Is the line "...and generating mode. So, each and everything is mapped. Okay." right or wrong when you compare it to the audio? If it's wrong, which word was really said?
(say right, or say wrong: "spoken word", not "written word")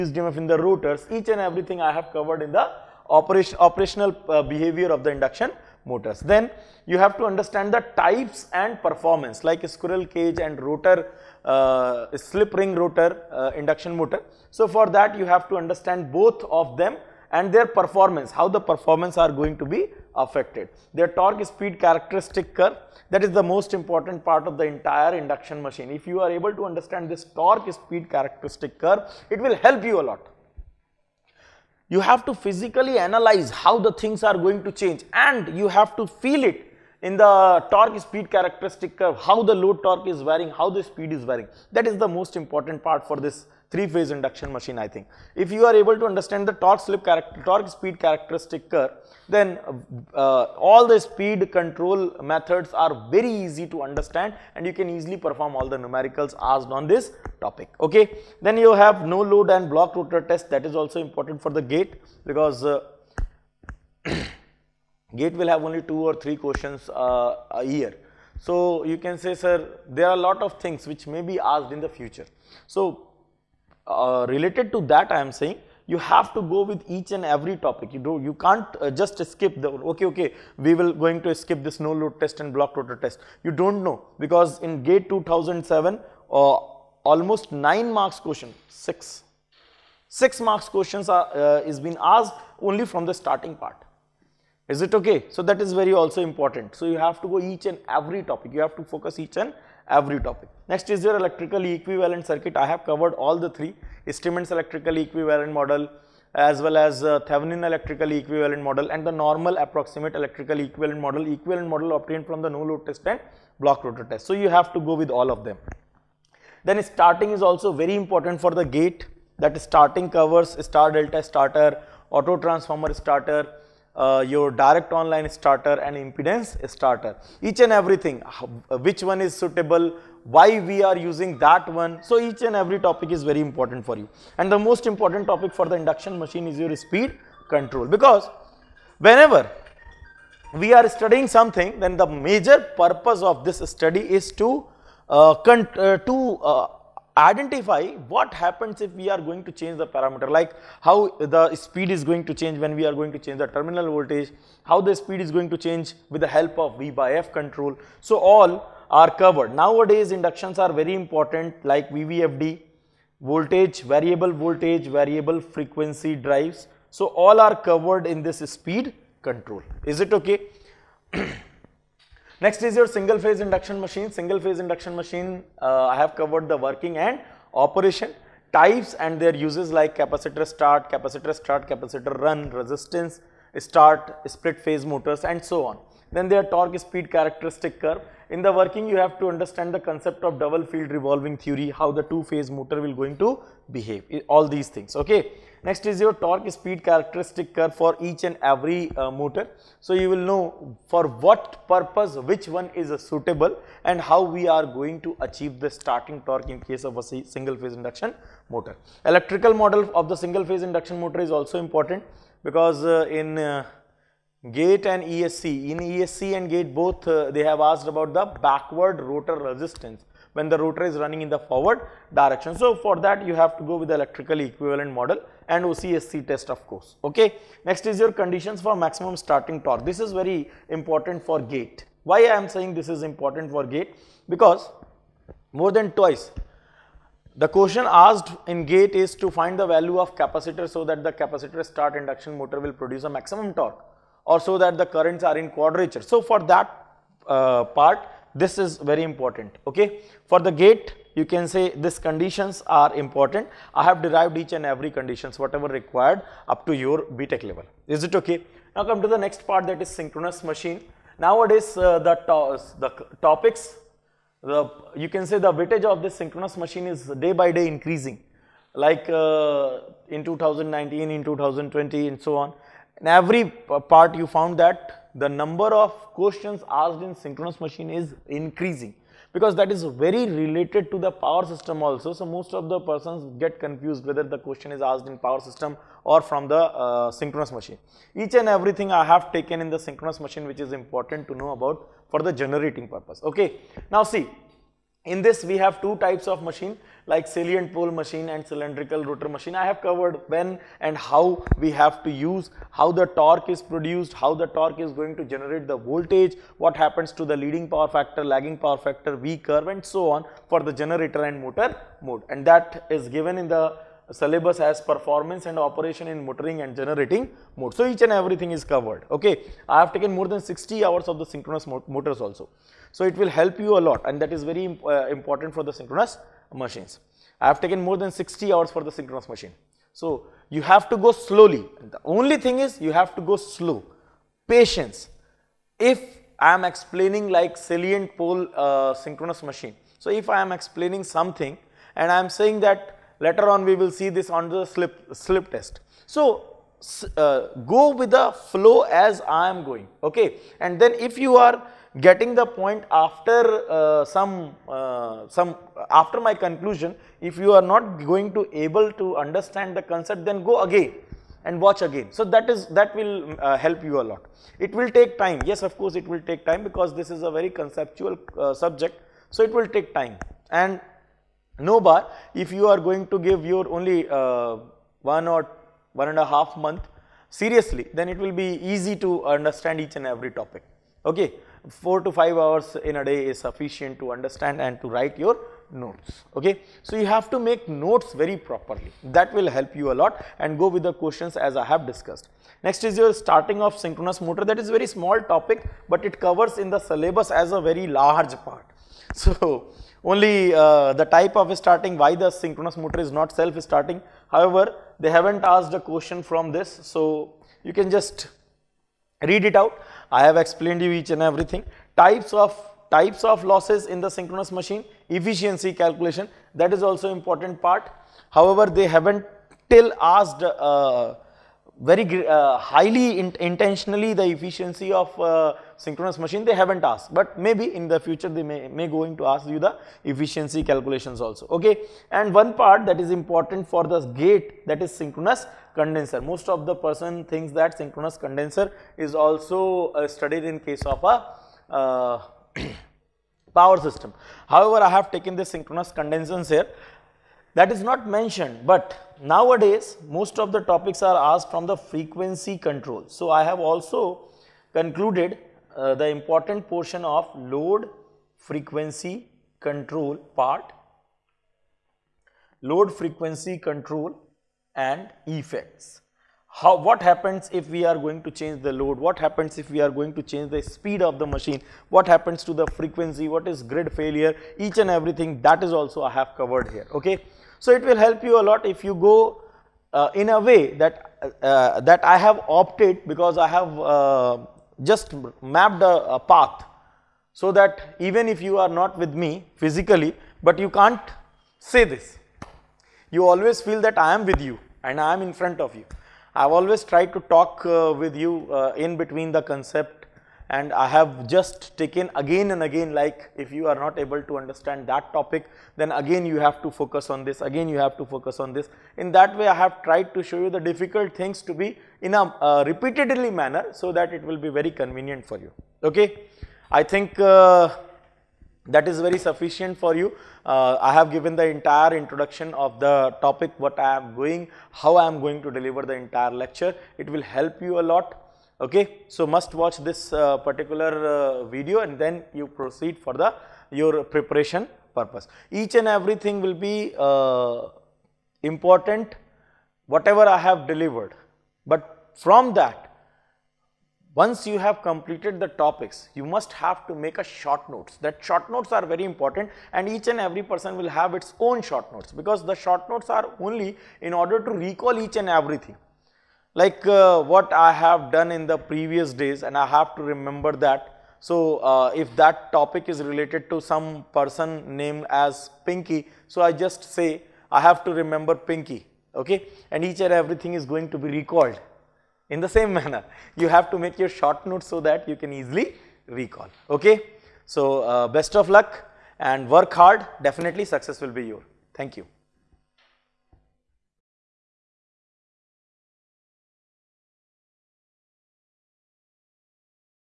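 wrong: "covered", not "mapped".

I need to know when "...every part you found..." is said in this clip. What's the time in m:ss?
4:33.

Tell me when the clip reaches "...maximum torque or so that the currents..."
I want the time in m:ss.
4:03.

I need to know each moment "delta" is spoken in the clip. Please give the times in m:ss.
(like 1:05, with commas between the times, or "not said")
2:00.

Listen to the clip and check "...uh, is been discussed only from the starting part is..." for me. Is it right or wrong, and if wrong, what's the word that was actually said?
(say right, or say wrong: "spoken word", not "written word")
wrong: "asked", not "discussed".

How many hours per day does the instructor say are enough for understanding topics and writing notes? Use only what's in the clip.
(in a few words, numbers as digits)
4 to 5 hours.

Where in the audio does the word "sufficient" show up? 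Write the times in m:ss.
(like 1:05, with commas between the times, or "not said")
6:23, 8:39.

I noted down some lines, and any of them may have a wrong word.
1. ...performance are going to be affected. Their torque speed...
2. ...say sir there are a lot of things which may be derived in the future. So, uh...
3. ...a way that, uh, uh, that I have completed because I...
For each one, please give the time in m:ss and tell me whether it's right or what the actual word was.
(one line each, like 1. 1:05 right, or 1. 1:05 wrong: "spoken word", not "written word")
1. 0:18 right
2. 1:09 wrong: "asked", not "derived"
3. 8:00 wrong: "opted", not "completed".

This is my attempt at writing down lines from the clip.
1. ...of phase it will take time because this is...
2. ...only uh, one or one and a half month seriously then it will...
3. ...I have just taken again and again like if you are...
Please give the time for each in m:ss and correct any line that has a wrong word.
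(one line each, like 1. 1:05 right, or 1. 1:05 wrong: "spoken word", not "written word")
1. 6:05 wrong: "course", not "phase"
2. 6:13 right
3. 8:20 right.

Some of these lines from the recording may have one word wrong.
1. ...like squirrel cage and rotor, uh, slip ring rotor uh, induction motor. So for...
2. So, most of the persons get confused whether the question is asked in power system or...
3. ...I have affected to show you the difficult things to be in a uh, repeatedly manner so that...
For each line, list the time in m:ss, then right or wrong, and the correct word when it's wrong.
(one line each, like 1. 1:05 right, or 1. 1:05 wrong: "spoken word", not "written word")
1. 0:09 right
2. 4:42 right
3. 8:29 wrong: "tried", not "affected".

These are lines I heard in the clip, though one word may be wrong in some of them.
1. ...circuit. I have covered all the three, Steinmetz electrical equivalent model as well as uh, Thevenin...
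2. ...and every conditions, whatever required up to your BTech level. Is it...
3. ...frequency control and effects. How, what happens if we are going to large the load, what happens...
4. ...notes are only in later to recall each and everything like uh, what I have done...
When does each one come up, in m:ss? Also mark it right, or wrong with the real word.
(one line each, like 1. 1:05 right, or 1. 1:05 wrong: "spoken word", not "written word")
1. 1:42 right
2. 4:14 right
3. 7:42 wrong: "change", not "large"
4. 9:12 wrong: "order", not "later".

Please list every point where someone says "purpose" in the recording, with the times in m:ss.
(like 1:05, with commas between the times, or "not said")
2:22, 3:21, 4:52, 8:54.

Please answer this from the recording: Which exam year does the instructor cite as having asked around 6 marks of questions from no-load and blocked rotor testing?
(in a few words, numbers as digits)
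2007.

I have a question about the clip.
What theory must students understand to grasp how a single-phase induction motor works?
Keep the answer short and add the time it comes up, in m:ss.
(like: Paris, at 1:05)
Double field revolving theory, at 3:10.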